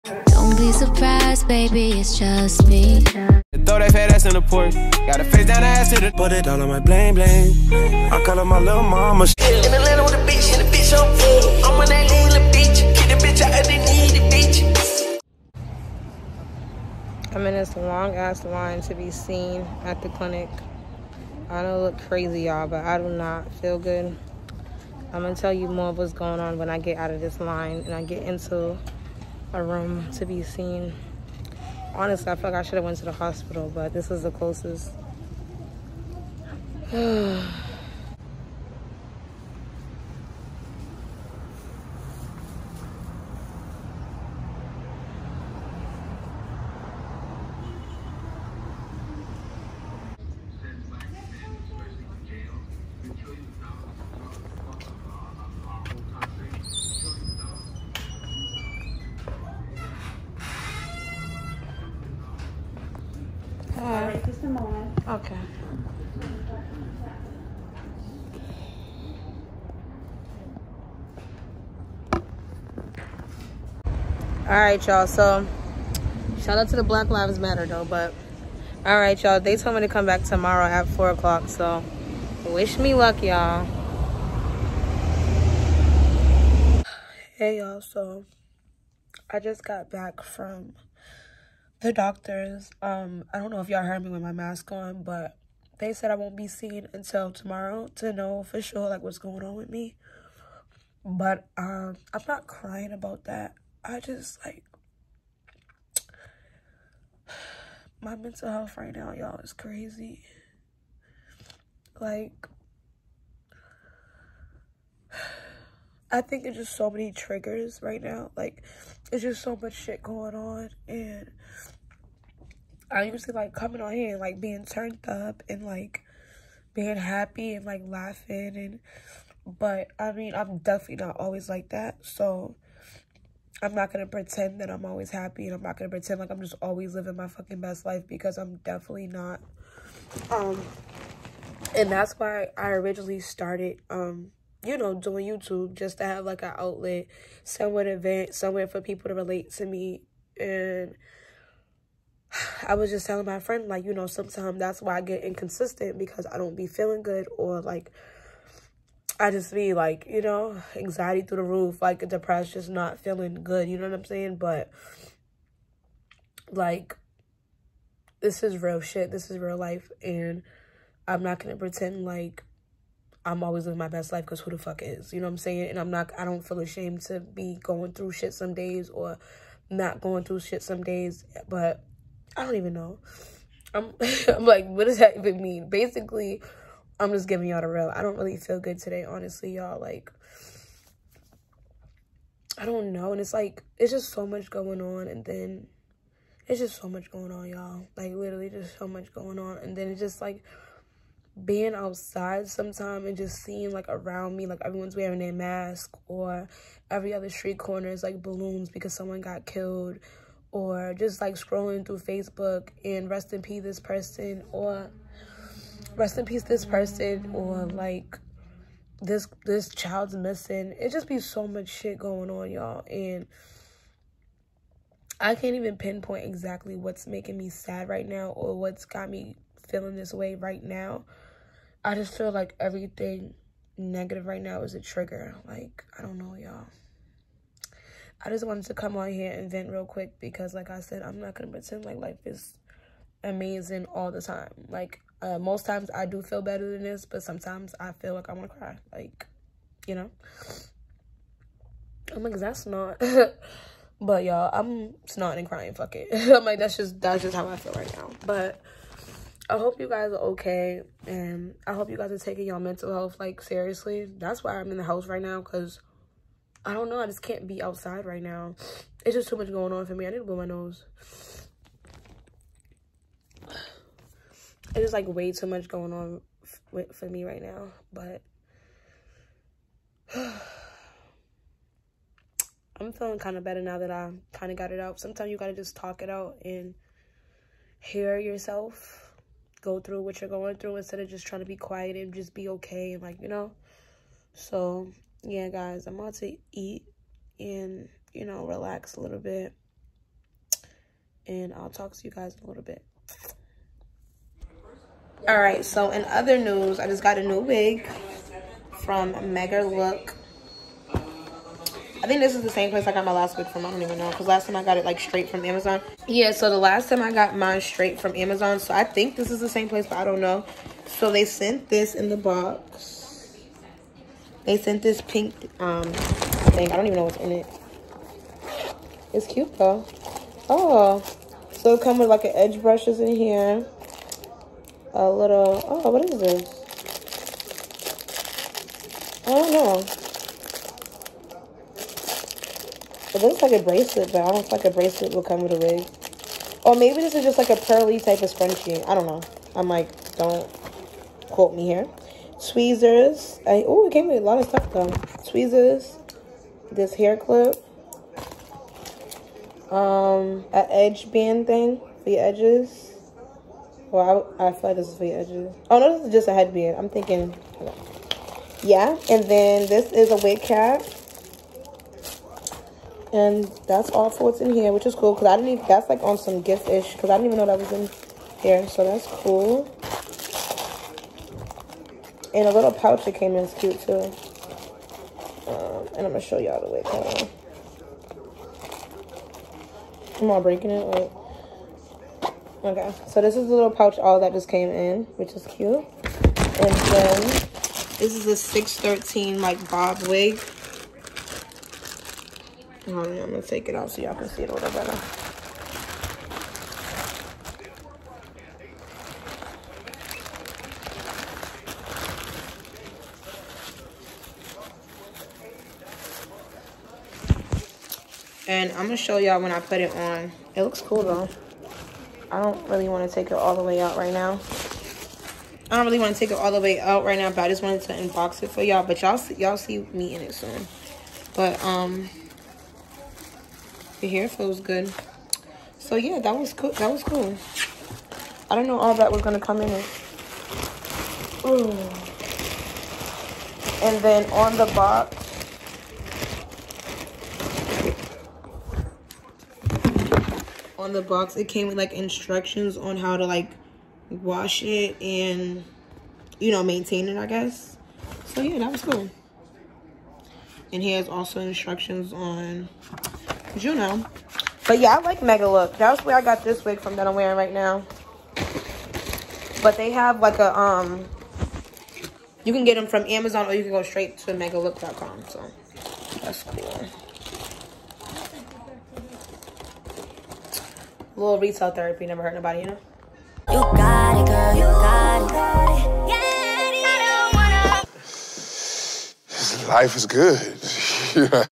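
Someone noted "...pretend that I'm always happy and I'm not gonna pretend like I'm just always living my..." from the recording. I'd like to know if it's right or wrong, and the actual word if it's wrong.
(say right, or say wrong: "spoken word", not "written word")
right.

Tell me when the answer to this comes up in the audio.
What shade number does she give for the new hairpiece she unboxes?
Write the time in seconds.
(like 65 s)
398 s.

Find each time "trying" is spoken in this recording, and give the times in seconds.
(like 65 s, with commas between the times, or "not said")
291 s.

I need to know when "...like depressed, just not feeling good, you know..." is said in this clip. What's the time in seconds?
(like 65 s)
161 s.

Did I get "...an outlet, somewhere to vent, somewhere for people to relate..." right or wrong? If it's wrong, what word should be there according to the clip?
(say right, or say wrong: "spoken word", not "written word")
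right.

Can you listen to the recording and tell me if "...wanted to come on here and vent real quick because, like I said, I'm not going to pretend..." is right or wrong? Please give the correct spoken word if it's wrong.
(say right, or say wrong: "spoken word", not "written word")
right.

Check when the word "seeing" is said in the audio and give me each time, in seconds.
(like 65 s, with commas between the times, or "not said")
203 s.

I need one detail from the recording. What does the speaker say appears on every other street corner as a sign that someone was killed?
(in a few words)
Balloons.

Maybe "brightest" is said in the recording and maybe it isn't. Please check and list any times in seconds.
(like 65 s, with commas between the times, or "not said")
not said.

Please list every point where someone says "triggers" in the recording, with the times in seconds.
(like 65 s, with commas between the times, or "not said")
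117 s, 234 s.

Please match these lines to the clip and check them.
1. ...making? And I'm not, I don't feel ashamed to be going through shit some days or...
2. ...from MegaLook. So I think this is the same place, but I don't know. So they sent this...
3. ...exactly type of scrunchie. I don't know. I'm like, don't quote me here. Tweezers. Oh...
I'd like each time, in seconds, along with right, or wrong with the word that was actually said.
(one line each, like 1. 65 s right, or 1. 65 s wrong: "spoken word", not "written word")
1. 175 s wrong: "saying", not "making"
2. 318 s wrong: "Amazon", not "MegaLook"
3. 347 s wrong: "pearly", not "exactly".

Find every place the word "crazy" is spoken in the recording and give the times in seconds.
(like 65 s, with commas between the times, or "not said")
21 s, 109 s.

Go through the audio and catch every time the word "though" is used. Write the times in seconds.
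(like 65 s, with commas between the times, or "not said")
77 s, 329 s, 354 s, 421 s.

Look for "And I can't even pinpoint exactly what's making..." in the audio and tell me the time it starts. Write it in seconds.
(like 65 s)
222 s.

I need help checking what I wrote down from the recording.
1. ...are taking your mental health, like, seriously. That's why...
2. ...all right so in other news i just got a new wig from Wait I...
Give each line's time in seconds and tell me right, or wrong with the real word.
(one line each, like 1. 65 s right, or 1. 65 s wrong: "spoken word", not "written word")
1. 262 s right
2. 305 s wrong: "MegaLook", not "Wait".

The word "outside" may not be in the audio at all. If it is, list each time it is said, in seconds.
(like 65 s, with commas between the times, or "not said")
201 s, 267 s.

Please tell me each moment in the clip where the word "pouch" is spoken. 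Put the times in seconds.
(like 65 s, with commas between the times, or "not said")
382 s, 393 s.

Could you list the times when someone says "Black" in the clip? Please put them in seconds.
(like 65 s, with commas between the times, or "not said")
76 s.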